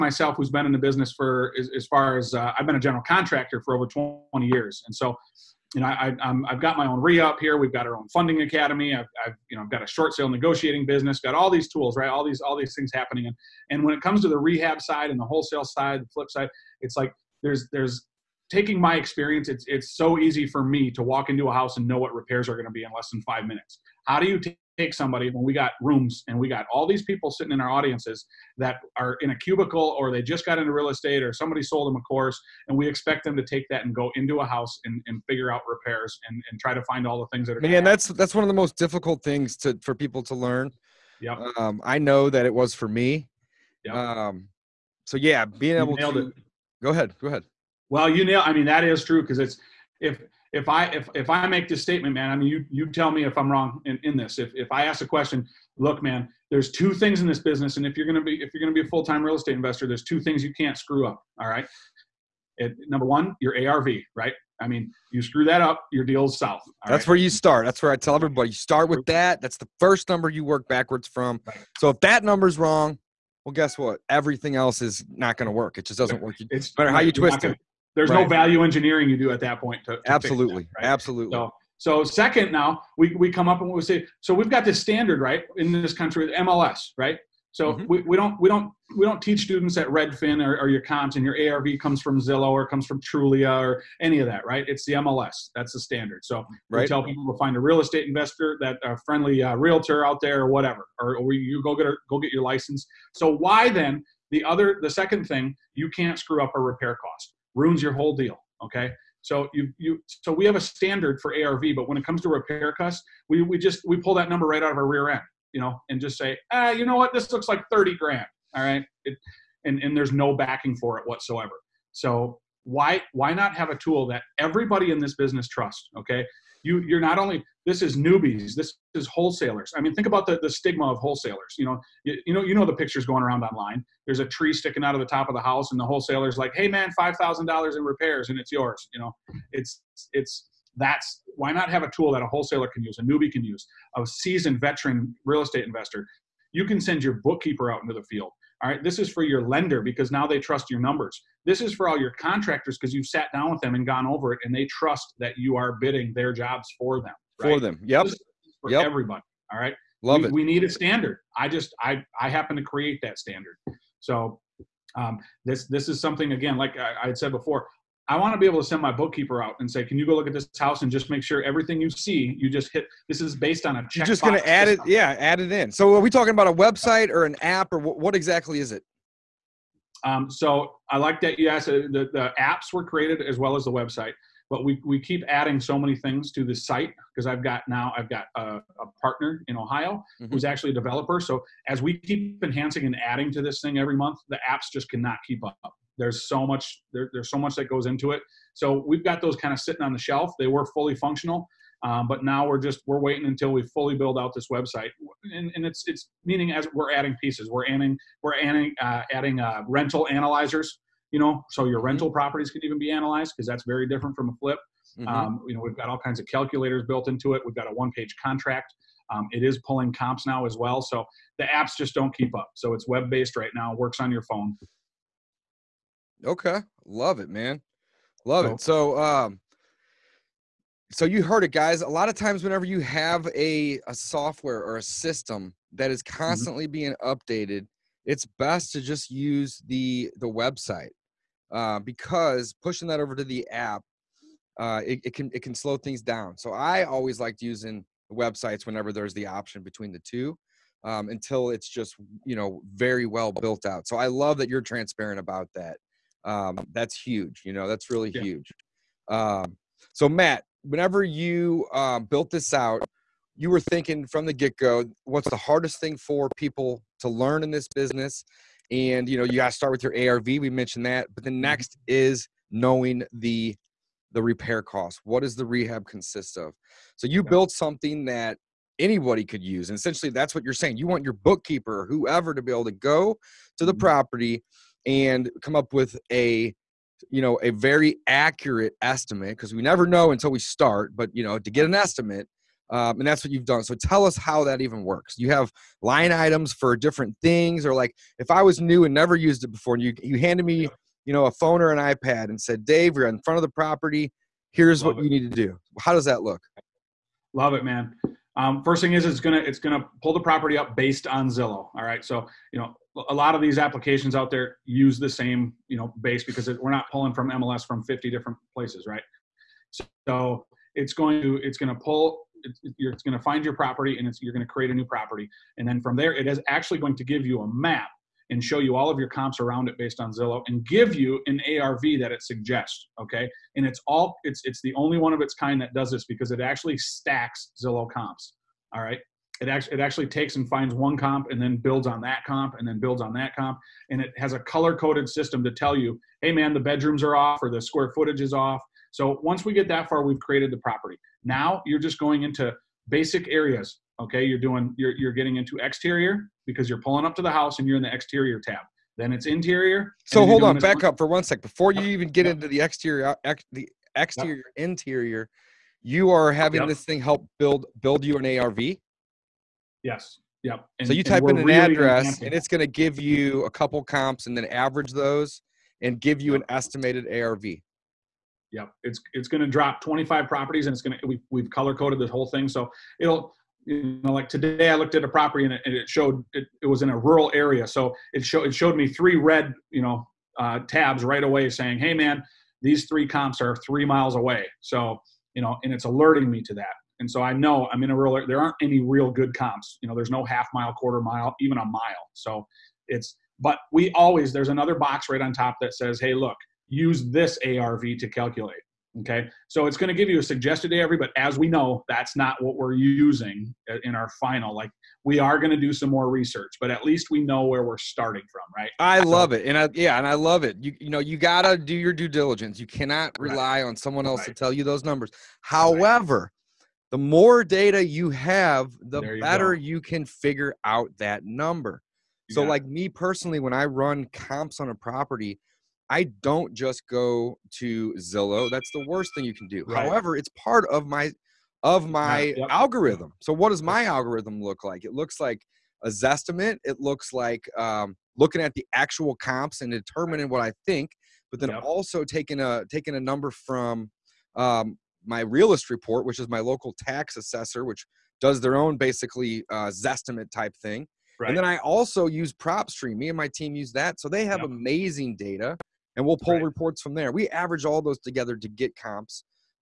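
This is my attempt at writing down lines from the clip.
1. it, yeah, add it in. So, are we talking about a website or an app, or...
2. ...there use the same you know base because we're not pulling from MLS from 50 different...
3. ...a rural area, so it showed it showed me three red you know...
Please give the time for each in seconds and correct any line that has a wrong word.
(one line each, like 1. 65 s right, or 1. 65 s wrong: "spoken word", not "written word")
1. 174 s right
2. 314 s right
3. 386 s right.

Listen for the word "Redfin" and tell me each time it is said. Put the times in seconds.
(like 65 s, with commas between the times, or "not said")
89 s.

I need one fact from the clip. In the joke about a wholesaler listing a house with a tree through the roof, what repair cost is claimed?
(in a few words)
$5000.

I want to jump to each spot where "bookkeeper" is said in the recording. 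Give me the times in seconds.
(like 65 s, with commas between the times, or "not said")
147 s, 168 s, 281 s.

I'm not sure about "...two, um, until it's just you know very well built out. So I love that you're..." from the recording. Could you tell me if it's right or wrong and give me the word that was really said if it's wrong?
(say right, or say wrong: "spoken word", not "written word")
right.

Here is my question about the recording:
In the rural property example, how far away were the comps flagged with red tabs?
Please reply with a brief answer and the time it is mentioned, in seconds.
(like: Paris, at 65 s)
3 miles, at 393 s.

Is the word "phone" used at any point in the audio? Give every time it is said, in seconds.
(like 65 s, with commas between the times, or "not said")
224 s, 301 s.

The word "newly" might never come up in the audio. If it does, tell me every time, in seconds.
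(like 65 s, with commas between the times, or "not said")
not said.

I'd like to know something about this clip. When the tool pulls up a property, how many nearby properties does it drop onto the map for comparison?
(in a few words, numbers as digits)
25.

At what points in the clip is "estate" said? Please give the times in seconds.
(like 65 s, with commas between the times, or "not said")
30 s, 59 s, 97 s, 145 s.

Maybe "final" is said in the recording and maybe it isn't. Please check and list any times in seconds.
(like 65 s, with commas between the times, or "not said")
414 s.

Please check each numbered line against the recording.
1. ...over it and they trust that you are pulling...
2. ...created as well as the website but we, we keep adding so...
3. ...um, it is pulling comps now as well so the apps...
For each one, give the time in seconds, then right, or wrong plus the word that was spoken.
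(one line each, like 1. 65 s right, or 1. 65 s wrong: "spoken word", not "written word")
1. 154 s wrong: "bidding", not "pulling"
2. 182 s right
3. 219 s right.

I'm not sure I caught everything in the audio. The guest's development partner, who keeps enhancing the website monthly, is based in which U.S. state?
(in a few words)
Ohio.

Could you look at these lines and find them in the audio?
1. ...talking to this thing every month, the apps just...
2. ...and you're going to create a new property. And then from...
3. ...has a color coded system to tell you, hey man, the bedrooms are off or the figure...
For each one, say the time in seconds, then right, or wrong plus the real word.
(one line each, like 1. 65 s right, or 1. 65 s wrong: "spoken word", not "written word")
1. 193 s wrong: "adding", not "talking"
2. 323 s right
3. 344 s wrong: "square", not "figure".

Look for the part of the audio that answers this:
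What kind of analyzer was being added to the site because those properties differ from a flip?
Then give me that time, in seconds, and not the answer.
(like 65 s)
209 s.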